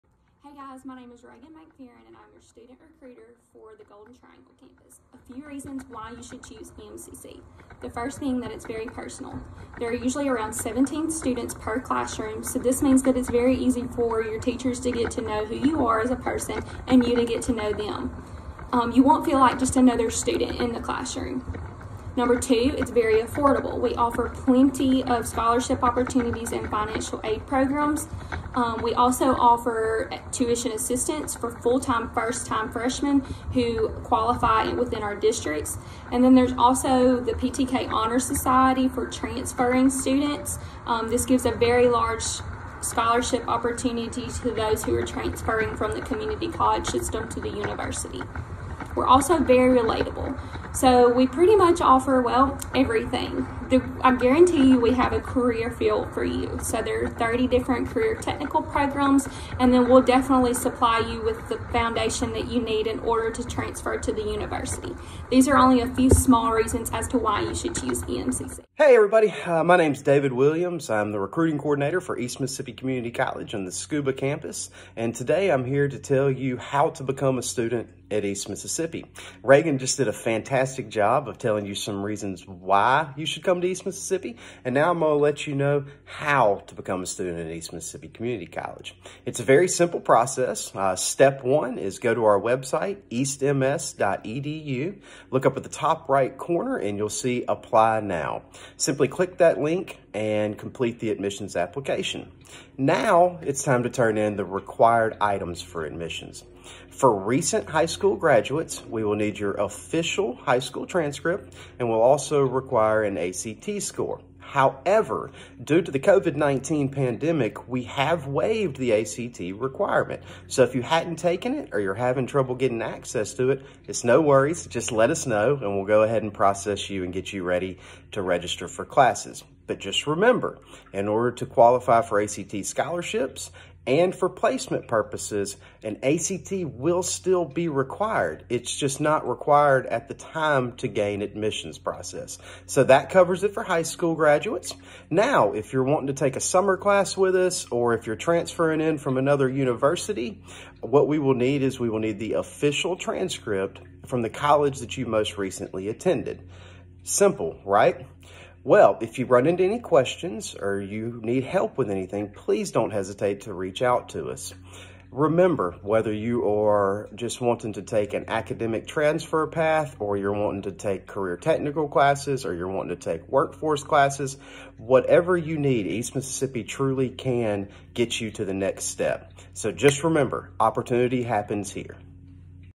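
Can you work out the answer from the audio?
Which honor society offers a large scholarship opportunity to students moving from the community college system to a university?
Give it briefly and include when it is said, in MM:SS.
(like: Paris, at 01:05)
PTK Honor Society, at 00:37.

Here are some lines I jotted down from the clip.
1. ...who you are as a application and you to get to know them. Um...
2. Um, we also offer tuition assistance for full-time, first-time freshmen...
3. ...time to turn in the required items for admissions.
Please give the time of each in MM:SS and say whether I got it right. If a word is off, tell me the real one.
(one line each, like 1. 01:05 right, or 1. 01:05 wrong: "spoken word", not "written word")
1. 00:15 wrong: "person", not "application"
2. 00:28 right
3. 01:43 right.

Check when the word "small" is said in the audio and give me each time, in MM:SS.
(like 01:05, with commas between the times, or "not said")
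01:06.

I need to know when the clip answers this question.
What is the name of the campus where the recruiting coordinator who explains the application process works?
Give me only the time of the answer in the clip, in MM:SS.
01:13.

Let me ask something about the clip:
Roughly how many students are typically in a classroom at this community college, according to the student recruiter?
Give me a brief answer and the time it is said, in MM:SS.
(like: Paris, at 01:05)
17, at 00:10.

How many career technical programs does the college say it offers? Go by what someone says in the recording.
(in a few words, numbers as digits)
30.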